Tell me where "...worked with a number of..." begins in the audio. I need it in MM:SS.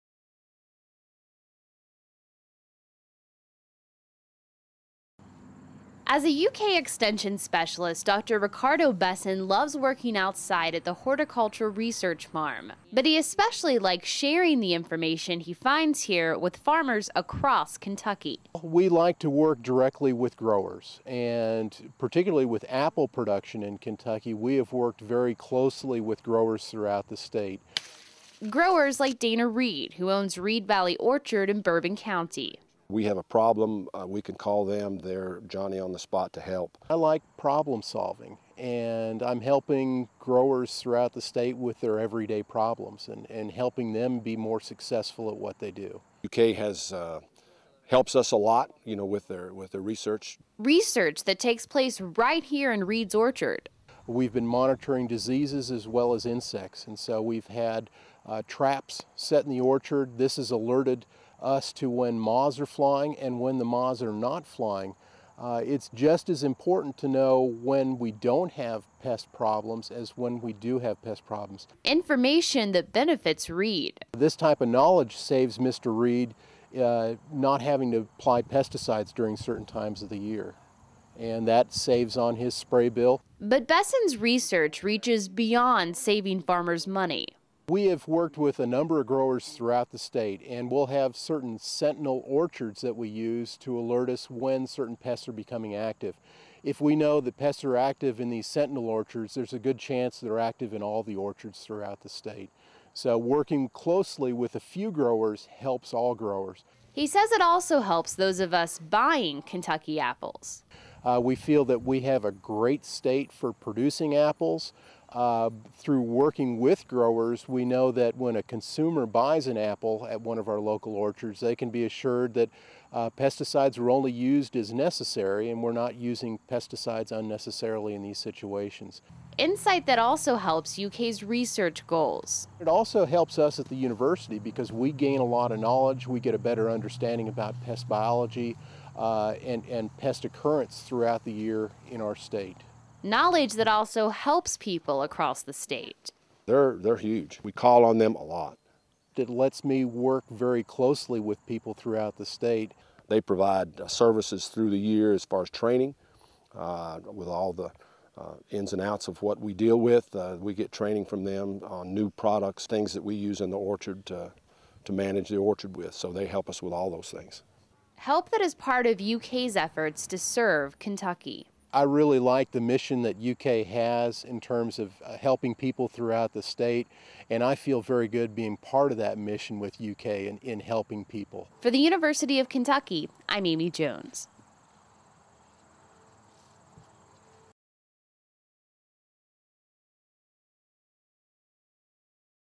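01:28.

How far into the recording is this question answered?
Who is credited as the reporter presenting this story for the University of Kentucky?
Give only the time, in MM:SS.
03:03.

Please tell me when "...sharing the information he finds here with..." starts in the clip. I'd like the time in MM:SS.
00:14.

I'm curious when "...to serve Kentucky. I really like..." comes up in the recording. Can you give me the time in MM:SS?
02:50.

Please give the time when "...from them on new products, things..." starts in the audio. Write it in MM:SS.
02:41.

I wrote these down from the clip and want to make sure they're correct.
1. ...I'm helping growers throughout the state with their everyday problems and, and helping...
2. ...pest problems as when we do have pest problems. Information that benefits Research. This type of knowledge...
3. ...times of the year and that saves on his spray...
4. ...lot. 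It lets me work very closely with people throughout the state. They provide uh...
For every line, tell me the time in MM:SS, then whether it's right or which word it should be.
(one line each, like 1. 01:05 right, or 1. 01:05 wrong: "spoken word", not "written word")
1. 00:39 right
2. 01:09 wrong: "Reed", not "Research"
3. 01:19 right
4. 02:28 right.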